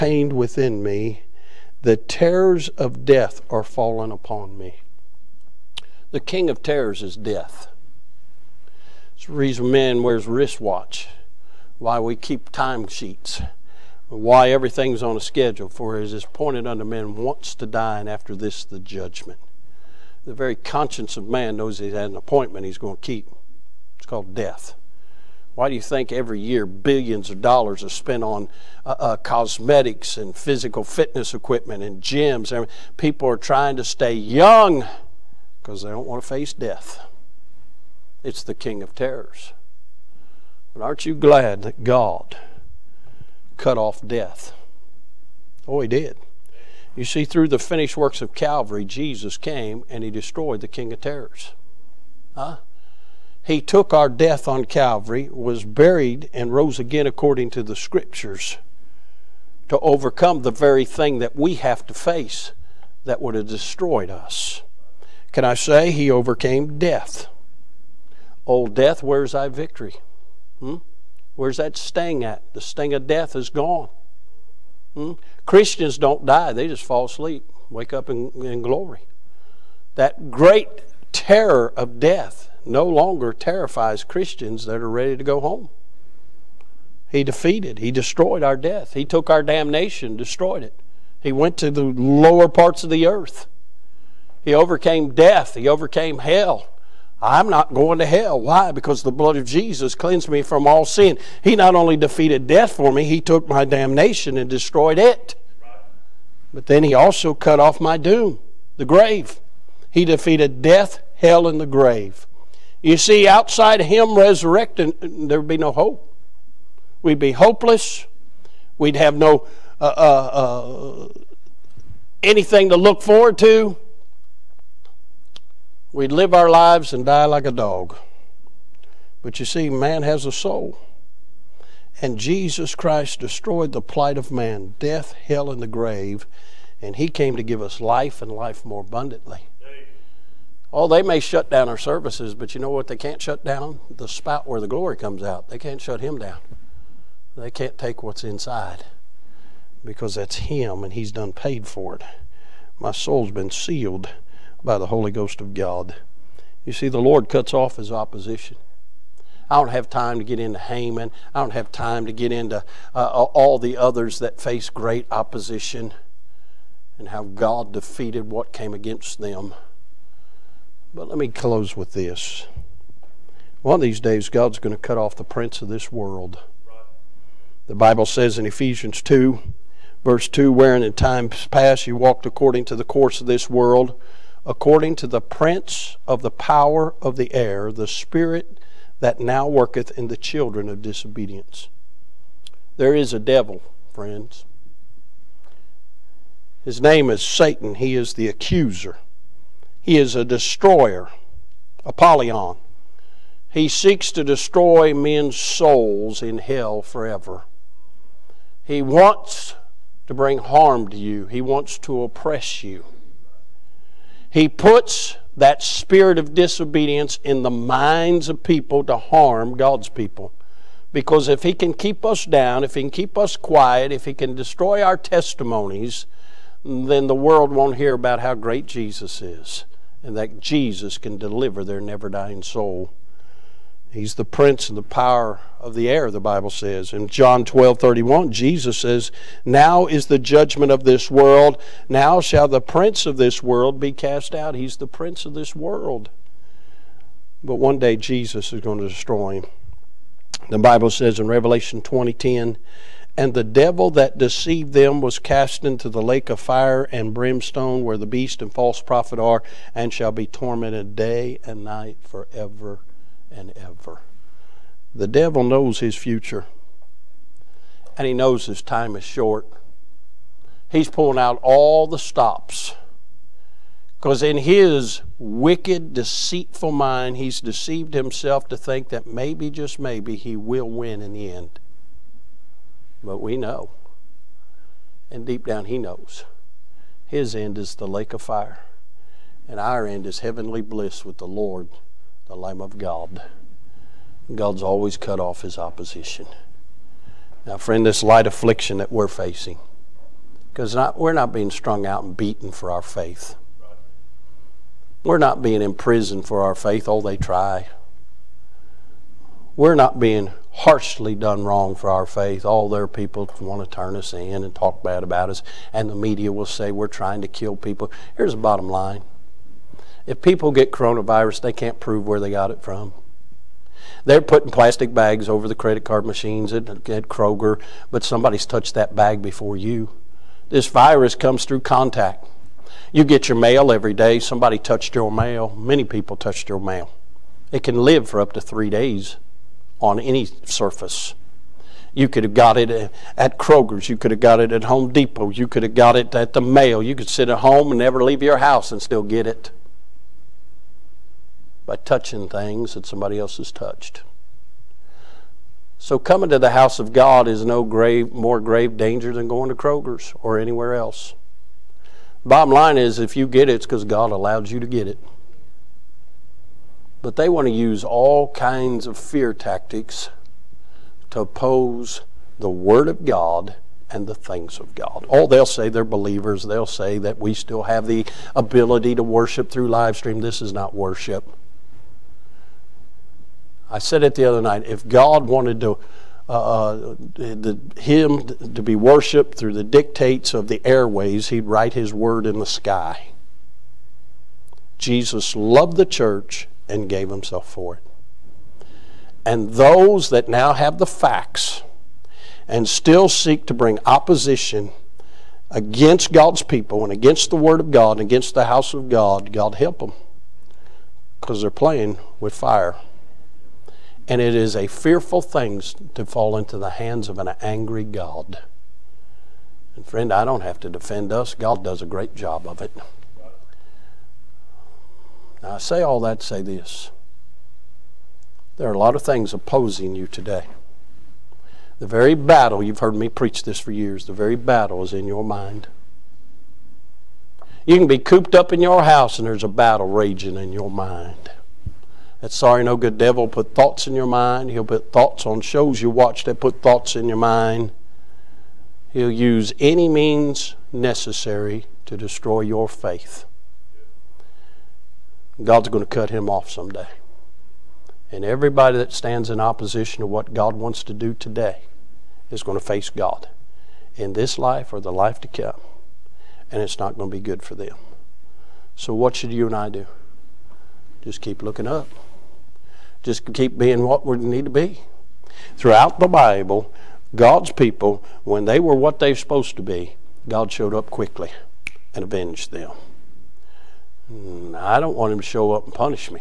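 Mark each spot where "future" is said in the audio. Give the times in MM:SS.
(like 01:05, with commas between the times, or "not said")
04:25.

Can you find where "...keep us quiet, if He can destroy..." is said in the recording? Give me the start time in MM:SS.
03:42.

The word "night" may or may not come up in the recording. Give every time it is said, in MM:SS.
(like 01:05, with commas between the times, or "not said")
04:21, 06:24.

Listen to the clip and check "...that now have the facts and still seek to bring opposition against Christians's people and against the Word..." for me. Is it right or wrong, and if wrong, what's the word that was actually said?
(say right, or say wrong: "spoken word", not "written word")
wrong: "God", not "Christians".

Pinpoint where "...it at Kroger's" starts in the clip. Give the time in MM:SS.
05:42.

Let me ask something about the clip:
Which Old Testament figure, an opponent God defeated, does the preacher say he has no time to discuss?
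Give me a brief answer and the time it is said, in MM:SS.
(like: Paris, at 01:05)
Haman, at 02:40.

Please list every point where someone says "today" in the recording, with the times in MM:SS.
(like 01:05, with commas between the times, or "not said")
07:10, 07:41.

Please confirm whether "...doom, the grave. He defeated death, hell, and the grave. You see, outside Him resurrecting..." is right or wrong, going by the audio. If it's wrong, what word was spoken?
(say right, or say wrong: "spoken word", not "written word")
right.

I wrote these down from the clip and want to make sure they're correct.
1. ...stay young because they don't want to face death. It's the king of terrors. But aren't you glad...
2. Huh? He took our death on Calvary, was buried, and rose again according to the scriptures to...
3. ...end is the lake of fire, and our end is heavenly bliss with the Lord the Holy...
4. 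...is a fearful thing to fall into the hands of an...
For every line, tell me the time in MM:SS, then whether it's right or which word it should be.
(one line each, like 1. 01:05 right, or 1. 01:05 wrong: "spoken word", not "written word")
1. 00:33 right
2. 00:52 right
3. 04:47 wrong: "Lamb", not "Holy"
4. 06:54 right.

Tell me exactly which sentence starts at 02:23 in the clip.
The spout where the glory comes out.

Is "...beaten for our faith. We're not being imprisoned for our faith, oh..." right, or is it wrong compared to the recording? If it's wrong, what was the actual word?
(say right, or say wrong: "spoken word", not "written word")
right.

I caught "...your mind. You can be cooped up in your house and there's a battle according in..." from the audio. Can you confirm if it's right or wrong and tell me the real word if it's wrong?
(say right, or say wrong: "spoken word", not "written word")
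wrong: "raging", not "according".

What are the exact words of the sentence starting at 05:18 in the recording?
Here's the bottom line if people get coronavirus, they can't prove where they got it from.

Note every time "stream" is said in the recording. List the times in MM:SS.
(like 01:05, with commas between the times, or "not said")
06:19.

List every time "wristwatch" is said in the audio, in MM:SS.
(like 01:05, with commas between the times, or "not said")
00:10.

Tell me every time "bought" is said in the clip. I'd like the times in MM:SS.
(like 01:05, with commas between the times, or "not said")
not said.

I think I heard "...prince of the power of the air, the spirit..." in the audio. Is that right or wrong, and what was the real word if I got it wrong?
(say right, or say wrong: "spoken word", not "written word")
right.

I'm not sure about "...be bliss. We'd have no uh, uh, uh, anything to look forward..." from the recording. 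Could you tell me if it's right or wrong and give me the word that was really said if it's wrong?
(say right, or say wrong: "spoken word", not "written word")
wrong: "hopeless", not "bliss".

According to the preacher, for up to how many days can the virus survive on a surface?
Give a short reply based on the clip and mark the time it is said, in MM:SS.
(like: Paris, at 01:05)
3 days, at 05:38.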